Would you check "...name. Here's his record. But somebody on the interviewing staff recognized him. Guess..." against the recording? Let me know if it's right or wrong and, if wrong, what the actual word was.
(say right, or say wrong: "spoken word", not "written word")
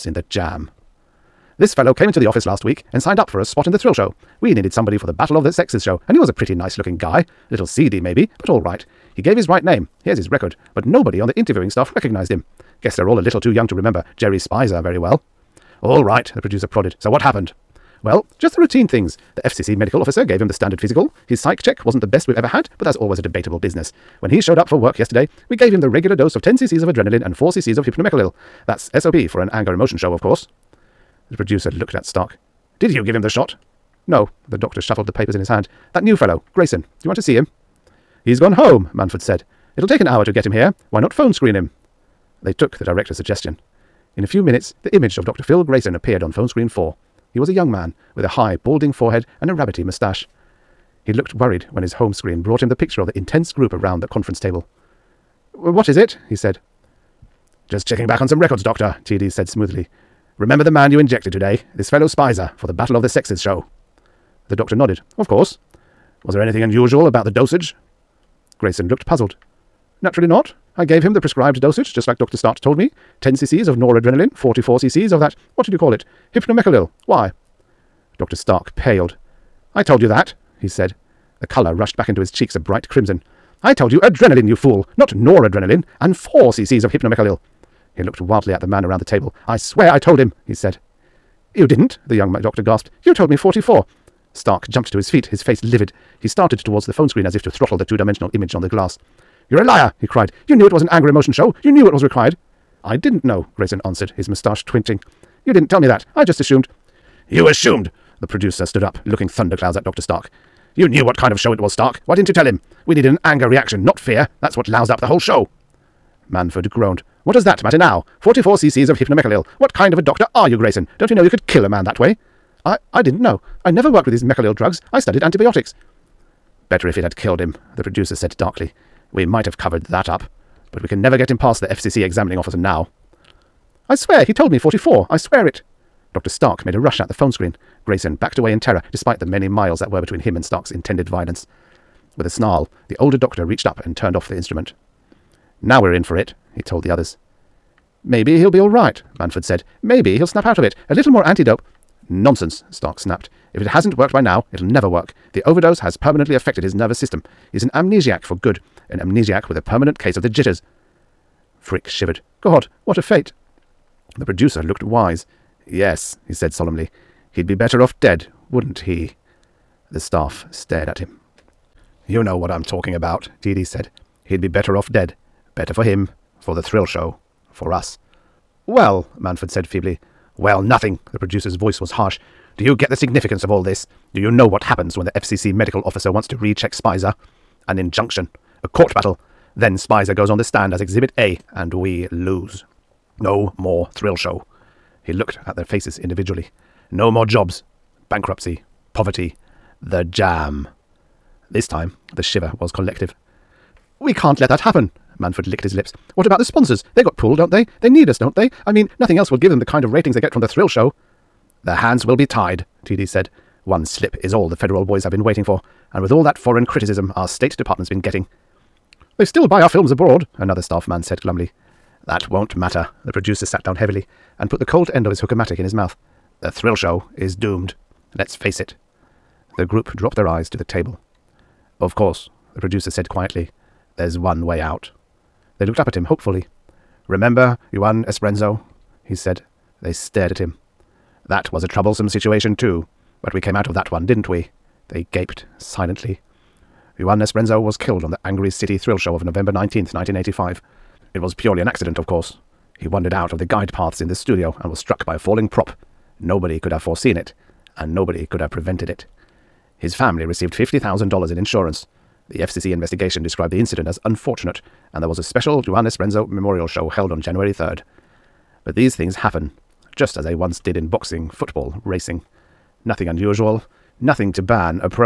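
wrong: "nobody", not "somebody".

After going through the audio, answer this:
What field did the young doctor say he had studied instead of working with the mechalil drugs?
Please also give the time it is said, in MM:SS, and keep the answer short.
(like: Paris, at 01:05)
antibiotics, at 02:05.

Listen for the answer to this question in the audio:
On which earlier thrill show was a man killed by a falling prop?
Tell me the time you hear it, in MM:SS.
04:08.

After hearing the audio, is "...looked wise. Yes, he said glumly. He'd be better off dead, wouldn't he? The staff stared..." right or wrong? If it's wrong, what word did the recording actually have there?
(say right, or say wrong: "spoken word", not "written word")
wrong: "solemnly", not "glumly".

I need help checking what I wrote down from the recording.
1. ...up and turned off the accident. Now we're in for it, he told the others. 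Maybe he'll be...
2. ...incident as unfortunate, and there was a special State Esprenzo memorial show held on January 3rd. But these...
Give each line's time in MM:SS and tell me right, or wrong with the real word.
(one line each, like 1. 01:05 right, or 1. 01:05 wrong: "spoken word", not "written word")
1. 02:23 wrong: "instrument", not "accident"
2. 04:23 wrong: "Juan", not "State".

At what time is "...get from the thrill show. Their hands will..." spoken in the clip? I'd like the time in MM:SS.
03:30.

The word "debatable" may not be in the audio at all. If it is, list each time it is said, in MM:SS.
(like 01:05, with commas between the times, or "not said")
00:23.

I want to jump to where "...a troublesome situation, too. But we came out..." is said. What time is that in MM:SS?
04:01.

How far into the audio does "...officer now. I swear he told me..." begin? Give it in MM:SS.
02:12.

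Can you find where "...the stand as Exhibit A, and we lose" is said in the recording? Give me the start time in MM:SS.
03:10.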